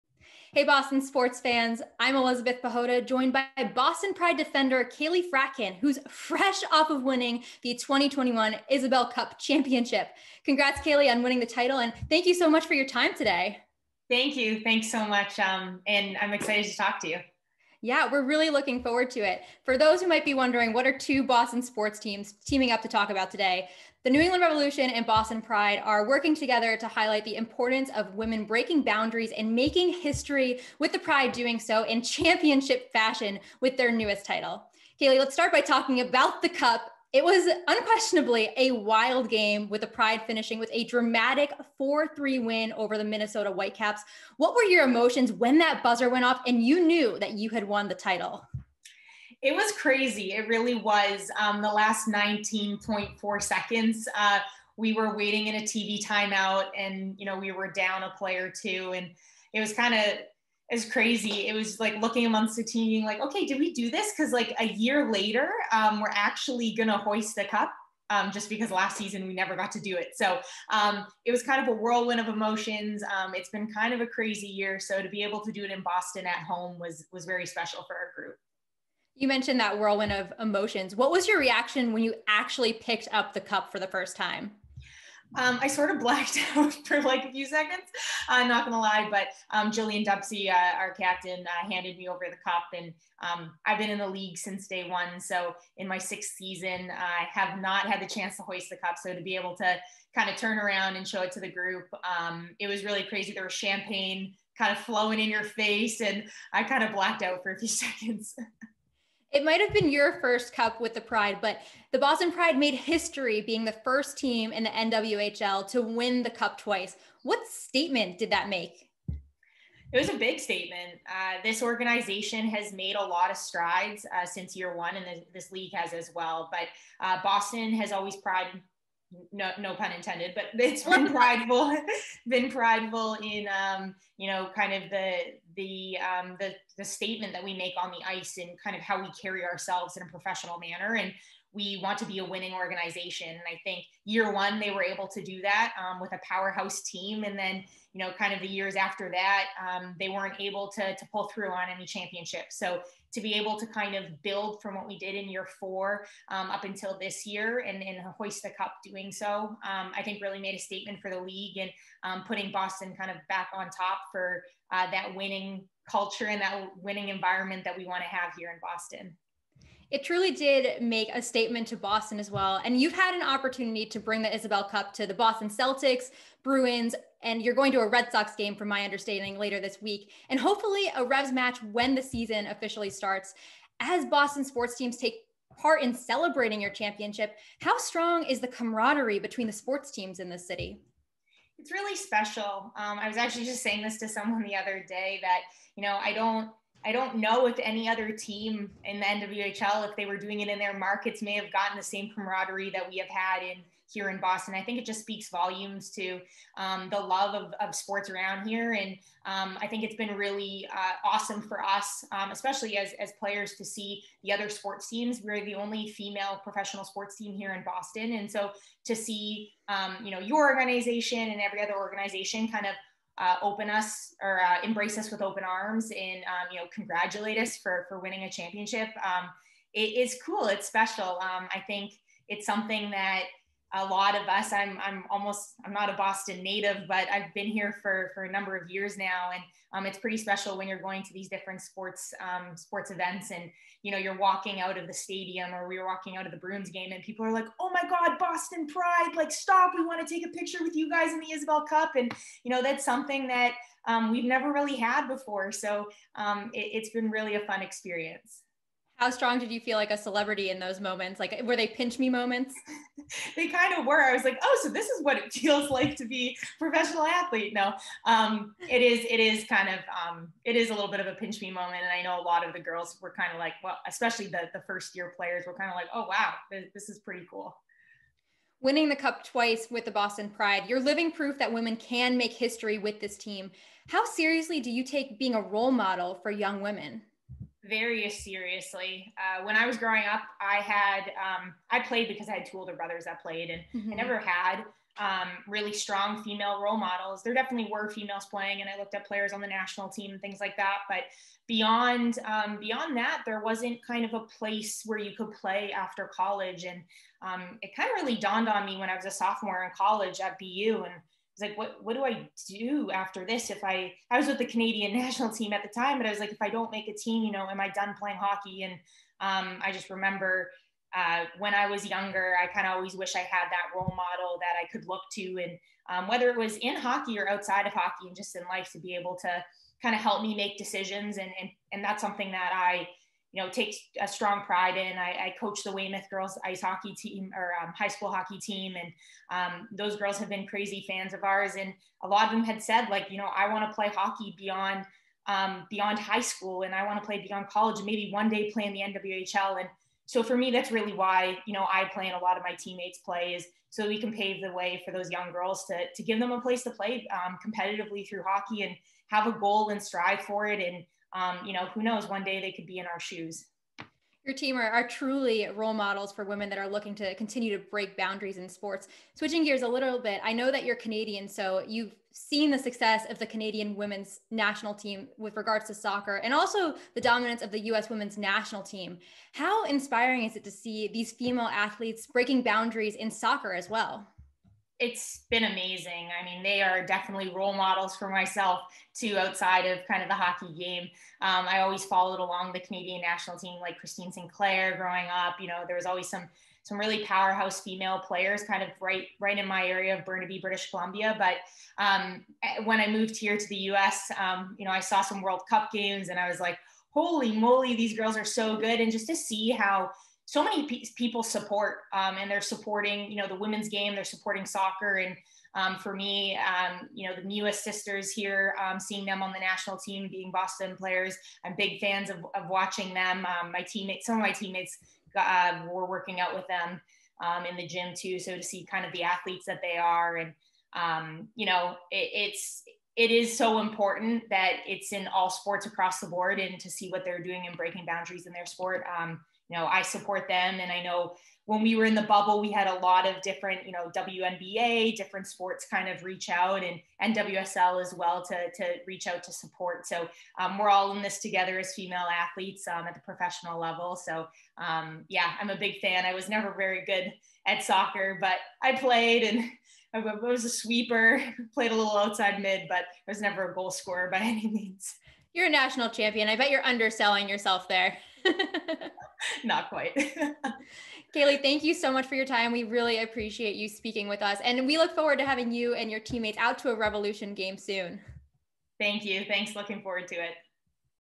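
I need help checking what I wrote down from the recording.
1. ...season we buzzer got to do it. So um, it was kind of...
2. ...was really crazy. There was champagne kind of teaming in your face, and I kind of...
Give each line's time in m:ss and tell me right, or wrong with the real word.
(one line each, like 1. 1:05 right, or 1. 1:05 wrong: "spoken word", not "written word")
1. 1:08 wrong: "never", not "buzzer"
2. 1:42 wrong: "flowing", not "teaming".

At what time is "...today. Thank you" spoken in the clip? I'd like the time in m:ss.
0:13.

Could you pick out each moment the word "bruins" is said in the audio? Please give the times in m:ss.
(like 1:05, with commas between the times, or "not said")
2:56, 4:06.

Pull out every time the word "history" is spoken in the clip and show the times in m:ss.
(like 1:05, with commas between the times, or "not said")
0:29, 1:52, 4:42.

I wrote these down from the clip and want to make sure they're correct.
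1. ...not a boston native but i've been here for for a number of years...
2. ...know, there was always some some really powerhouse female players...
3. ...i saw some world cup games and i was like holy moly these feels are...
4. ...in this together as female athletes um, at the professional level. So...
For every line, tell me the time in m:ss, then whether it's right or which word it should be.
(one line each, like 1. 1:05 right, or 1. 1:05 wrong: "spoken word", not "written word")
1. 3:55 right
2. 6:35 right
3. 6:44 wrong: "girls", not "feels"
4. 7:30 right.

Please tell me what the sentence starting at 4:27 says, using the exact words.
No, um, it is, it is kind of, um, it is a little bit of a pinch me moment.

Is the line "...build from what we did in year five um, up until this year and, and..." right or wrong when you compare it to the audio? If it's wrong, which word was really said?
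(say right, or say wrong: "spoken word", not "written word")
wrong: "four", not "five".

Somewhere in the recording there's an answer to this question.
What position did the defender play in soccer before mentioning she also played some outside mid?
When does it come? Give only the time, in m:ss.
7:40.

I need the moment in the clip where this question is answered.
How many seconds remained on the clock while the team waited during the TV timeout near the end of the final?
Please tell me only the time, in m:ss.
0:52.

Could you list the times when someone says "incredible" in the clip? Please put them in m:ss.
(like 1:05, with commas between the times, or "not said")
not said.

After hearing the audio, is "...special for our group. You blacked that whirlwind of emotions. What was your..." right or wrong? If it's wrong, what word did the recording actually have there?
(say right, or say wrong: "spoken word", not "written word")
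wrong: "mentioned", not "blacked".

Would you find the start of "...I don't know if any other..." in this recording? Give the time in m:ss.
3:16.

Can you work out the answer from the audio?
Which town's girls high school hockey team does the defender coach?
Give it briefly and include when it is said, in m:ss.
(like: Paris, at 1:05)
Weymouth, at 5:35.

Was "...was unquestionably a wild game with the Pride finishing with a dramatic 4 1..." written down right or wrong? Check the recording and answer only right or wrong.
wrong.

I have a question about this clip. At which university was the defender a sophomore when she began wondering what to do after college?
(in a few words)
BU.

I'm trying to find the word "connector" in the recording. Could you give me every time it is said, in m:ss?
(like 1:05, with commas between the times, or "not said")
not said.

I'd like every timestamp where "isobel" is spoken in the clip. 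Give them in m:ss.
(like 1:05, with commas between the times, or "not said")
0:08, 2:54, 4:11.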